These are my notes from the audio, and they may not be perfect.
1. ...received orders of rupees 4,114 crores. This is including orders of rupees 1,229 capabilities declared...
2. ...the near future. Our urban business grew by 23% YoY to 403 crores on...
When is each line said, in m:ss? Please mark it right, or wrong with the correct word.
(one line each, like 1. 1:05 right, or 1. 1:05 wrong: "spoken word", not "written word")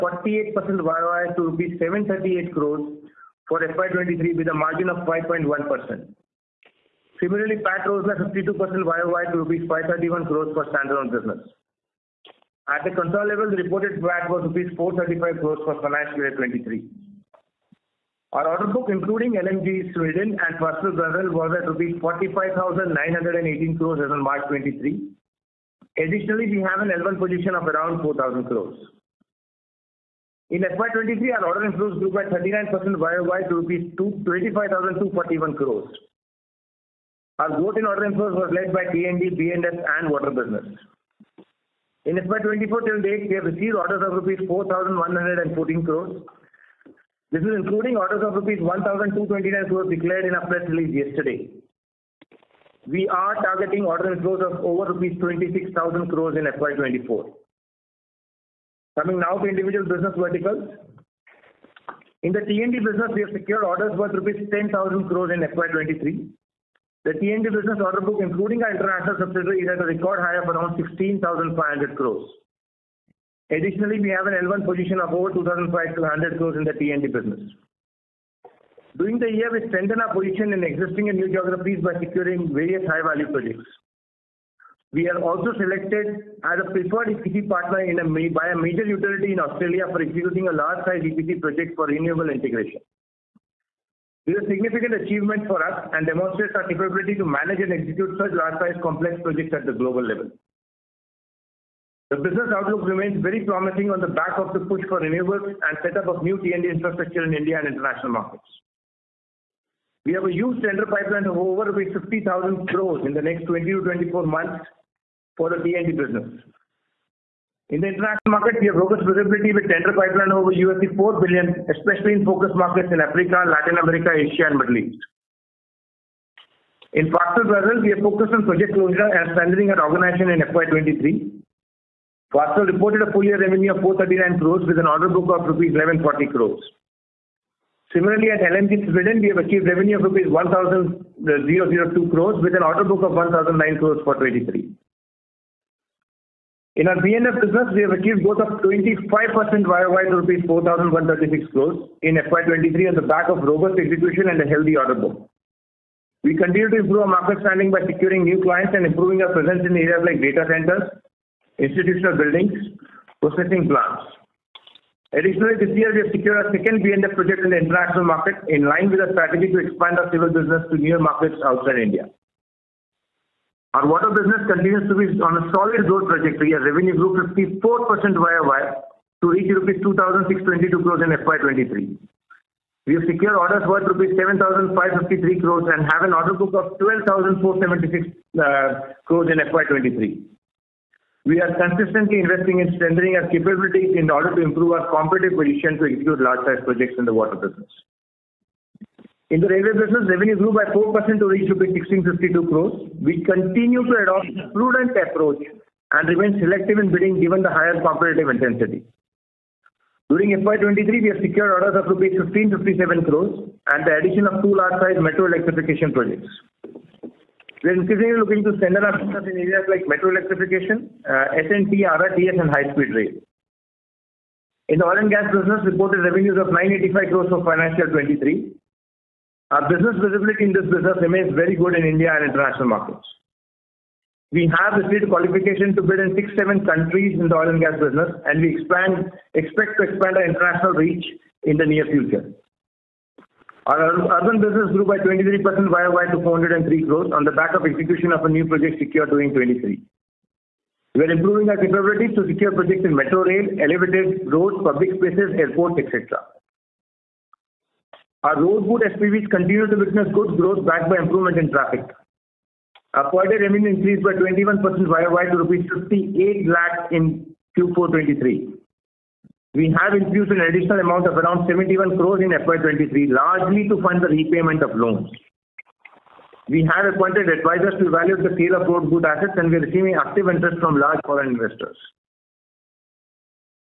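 1. 0:43 wrong: "crores", not "capabilities"
2. 4:01 right.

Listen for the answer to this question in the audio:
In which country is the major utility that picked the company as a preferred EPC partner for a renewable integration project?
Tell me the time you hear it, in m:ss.
1:29.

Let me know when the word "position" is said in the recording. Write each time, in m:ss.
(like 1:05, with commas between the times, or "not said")
0:27, 1:14, 1:20, 3:15.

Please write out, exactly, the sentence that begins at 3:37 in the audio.
We are increasingly looking to strengthen our business in areas like metro electrification, uh, SNT, RRTS, and high-speed rail.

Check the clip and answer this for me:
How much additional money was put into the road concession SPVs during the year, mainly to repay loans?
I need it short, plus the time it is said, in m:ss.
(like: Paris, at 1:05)
71 crore, at 4:31.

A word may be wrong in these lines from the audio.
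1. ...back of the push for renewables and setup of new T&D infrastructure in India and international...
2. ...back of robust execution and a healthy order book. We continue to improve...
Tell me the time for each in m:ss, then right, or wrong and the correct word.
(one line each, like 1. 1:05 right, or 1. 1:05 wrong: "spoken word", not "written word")
1. 1:44 right
2. 2:33 right.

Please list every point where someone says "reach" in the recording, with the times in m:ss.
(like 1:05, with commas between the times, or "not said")
2:59, 3:21, 4:00.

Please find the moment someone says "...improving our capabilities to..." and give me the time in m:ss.
4:11.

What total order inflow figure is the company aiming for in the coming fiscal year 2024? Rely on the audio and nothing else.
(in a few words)
over 26,000 crores.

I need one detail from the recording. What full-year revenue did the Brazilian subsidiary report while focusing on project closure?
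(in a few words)
439 crores.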